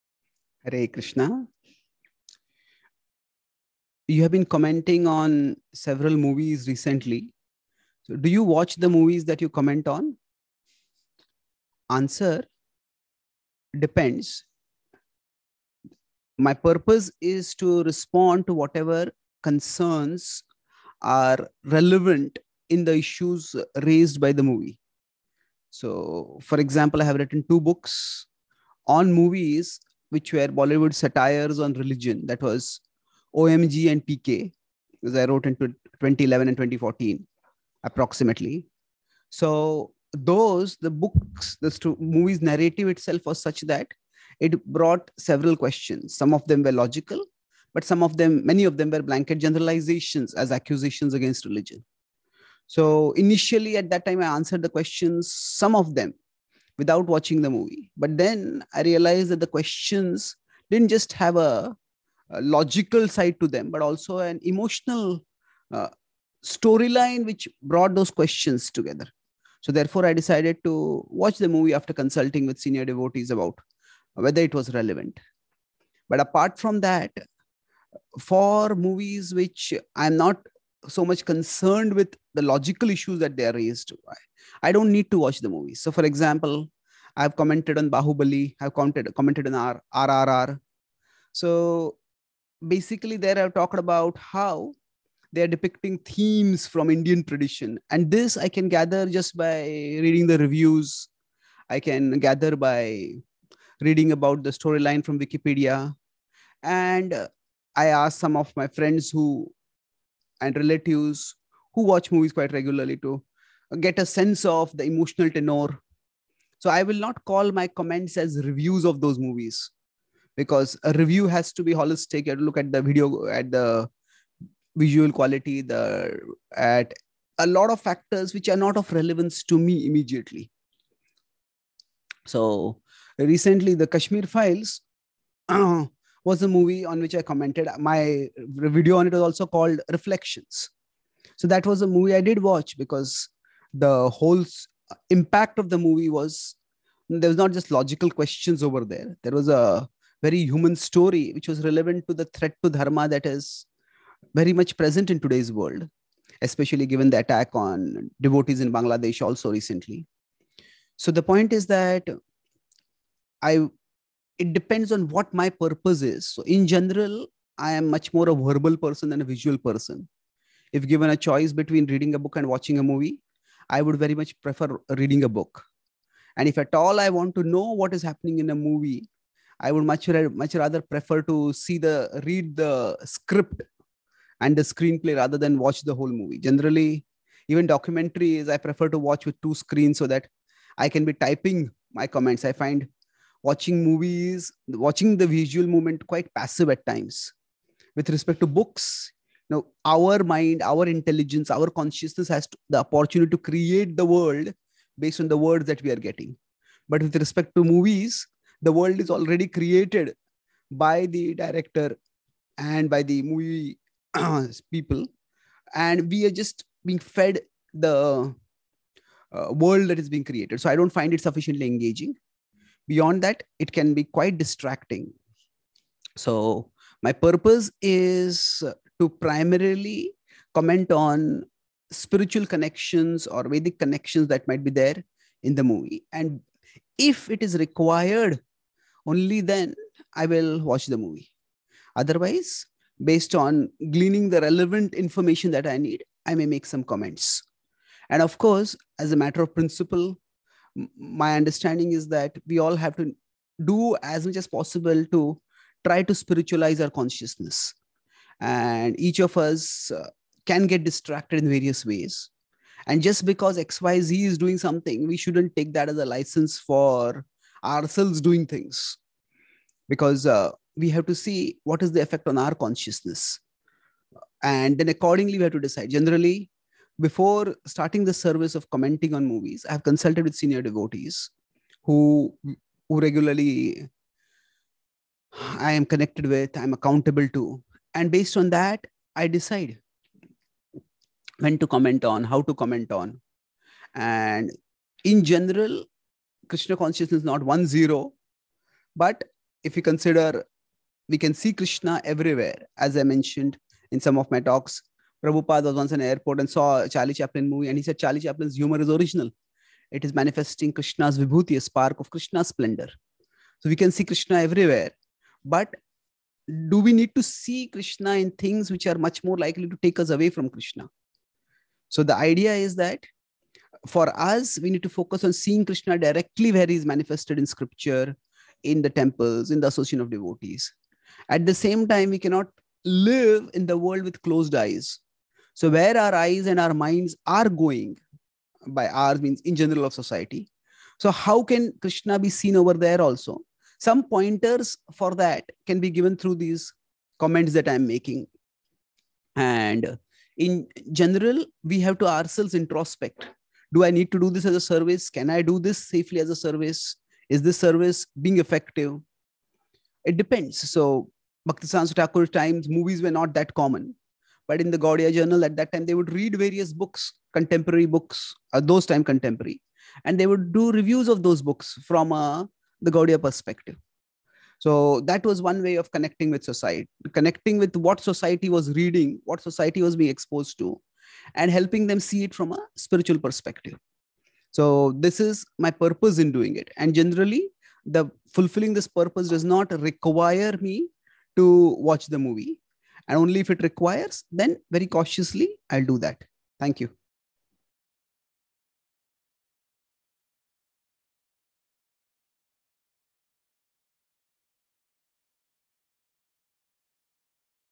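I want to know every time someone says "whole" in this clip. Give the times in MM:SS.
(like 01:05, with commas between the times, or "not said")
02:24, 03:05.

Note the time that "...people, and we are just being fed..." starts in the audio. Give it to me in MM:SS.
03:34.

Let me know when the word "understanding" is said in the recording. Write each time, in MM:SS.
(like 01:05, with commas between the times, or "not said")
04:11.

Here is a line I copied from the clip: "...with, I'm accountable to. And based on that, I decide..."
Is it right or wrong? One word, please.
right.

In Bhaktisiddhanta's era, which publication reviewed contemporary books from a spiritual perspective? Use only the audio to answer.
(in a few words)
Gaudiya journal.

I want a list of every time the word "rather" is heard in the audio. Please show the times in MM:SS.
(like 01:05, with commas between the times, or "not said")
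03:00, 03:05.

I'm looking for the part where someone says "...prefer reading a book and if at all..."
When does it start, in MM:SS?
02:54.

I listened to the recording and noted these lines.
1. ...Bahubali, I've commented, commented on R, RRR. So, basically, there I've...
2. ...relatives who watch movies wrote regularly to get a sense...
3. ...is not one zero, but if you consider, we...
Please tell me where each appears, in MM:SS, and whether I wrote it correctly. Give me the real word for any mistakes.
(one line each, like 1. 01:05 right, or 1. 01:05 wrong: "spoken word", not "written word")
1. 01:27 right
2. 01:50 wrong: "quite", not "wrote"
3. 04:57 right.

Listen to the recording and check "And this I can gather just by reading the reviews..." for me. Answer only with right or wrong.
right.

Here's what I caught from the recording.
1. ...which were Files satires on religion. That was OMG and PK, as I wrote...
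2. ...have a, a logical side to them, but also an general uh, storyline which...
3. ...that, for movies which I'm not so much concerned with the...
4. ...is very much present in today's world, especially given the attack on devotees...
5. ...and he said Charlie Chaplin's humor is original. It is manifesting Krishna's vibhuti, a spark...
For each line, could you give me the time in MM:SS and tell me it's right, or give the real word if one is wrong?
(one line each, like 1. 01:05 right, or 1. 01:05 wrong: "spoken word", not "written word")
1. 00:30 wrong: "Bollywood", not "Files"
2. 01:01 wrong: "emotional", not "general"
3. 01:16 right
4. 02:33 right
5. 05:07 right.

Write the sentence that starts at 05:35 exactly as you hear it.
So where our eyes and our minds are going, by ours means in general of society.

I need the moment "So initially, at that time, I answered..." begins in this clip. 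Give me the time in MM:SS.
00:52.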